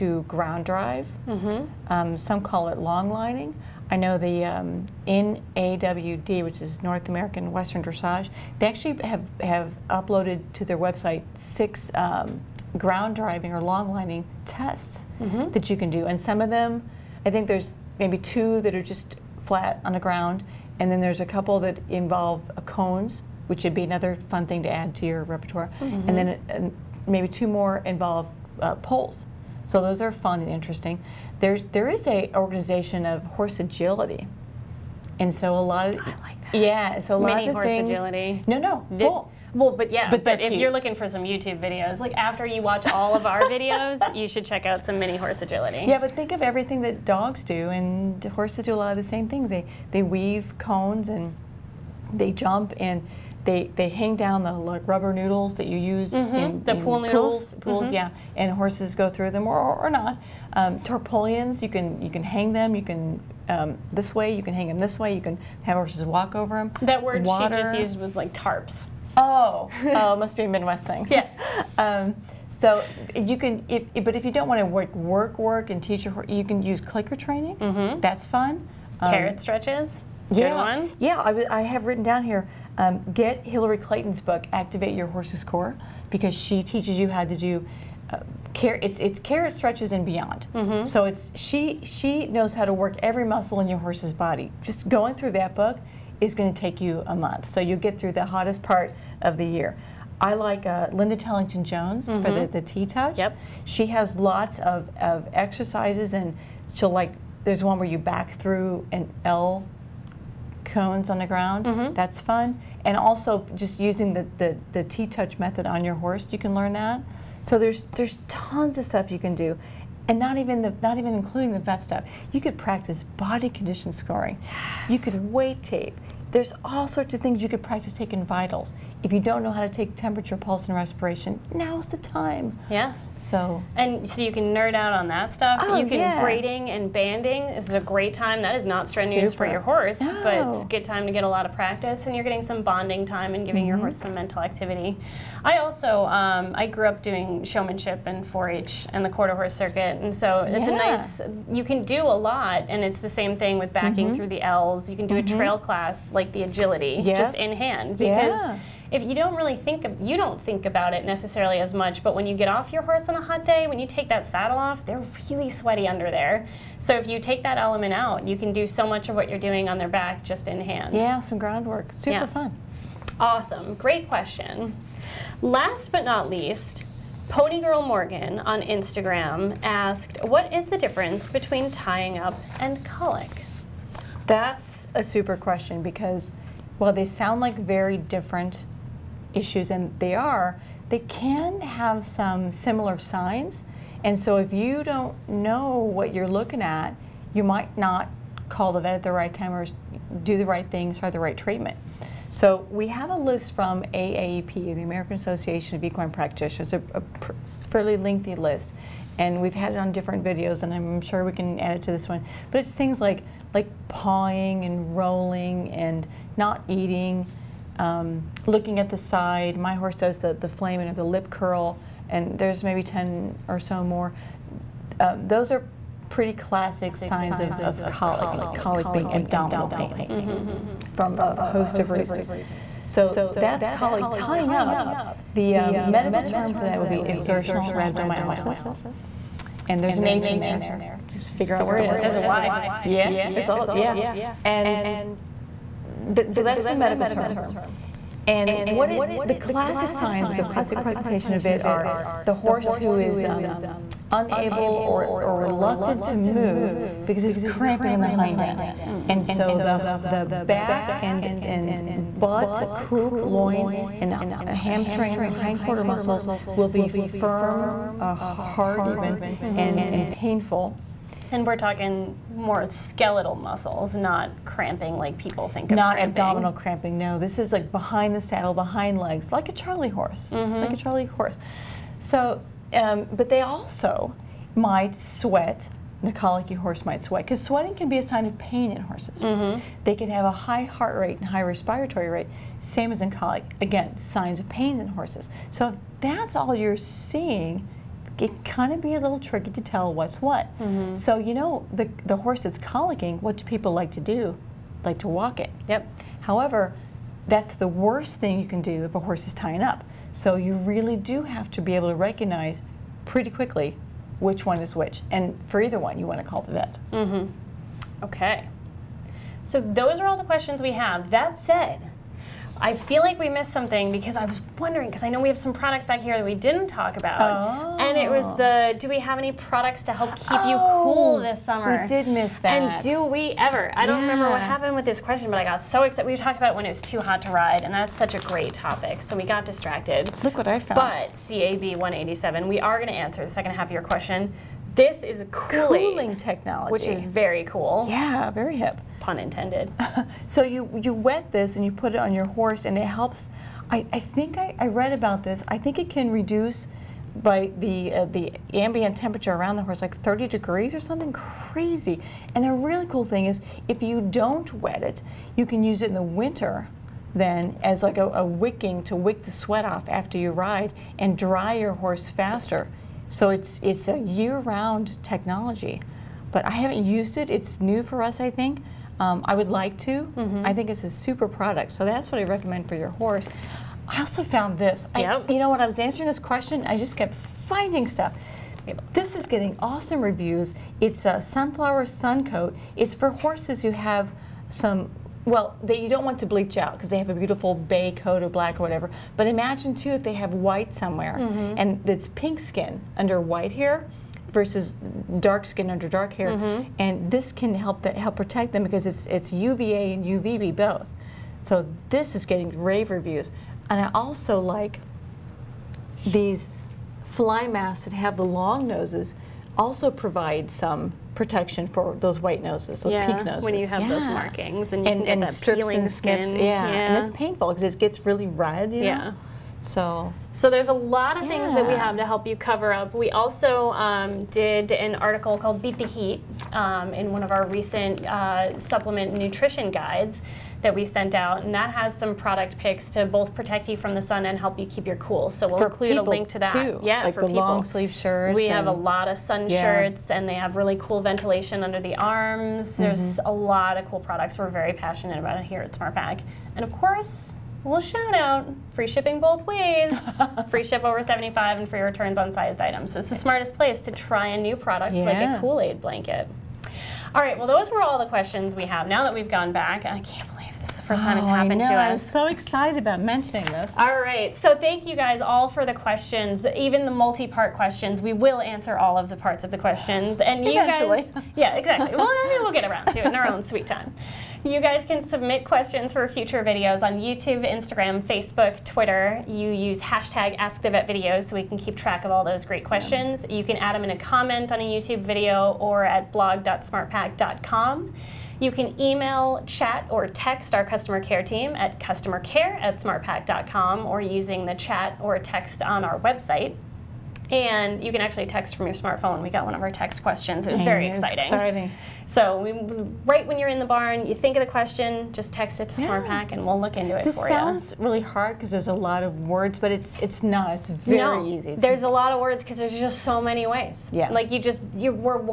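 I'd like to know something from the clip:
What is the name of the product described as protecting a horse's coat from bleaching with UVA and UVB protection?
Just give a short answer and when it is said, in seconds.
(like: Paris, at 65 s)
sunflower sun coat, at 391 s.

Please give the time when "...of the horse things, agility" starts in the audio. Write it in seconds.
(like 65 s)
37 s.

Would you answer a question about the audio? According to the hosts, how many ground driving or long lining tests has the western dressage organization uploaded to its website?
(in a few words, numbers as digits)
6.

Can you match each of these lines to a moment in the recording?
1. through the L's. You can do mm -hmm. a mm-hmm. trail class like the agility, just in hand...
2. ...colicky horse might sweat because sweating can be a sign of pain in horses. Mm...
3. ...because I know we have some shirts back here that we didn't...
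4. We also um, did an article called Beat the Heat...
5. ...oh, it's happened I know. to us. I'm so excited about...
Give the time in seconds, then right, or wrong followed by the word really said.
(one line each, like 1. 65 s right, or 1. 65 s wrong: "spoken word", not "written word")
1. 154 s right
2. 286 s right
3. 324 s wrong: "products", not "shirts"
4. 432 s right
5. 471 s right.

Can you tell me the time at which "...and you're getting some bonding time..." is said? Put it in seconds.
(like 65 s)
142 s.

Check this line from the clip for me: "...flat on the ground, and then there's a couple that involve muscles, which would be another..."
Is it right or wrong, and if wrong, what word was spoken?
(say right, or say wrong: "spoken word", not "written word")
wrong: "cones", not "muscles".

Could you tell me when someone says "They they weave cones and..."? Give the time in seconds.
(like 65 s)
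49 s.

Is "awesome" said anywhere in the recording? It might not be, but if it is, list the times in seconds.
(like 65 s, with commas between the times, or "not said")
173 s, 389 s.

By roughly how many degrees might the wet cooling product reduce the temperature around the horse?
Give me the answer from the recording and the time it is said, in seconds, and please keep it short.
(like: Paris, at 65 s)
30 degrees, at 360 s.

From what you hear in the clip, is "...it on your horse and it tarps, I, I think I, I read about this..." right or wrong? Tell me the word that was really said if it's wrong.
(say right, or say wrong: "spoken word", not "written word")
wrong: "helps", not "tarps".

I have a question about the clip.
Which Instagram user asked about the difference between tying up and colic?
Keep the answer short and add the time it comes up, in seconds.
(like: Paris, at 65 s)
Ponygirl Morgan, at 177 s.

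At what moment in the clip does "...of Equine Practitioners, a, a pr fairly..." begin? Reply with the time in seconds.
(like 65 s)
205 s.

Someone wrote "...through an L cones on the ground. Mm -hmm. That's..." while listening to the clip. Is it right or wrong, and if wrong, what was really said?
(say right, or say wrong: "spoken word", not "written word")
right.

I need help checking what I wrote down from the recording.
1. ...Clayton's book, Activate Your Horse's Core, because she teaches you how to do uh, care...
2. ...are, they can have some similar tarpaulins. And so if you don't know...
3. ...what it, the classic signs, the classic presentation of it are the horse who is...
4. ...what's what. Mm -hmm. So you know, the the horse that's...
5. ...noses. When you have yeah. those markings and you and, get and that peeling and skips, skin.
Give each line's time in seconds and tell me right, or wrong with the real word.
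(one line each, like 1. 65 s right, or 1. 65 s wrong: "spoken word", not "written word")
1. 83 s right
2. 190 s wrong: "signs", not "tarpaulins"
3. 248 s right
4. 299 s right
5. 423 s right.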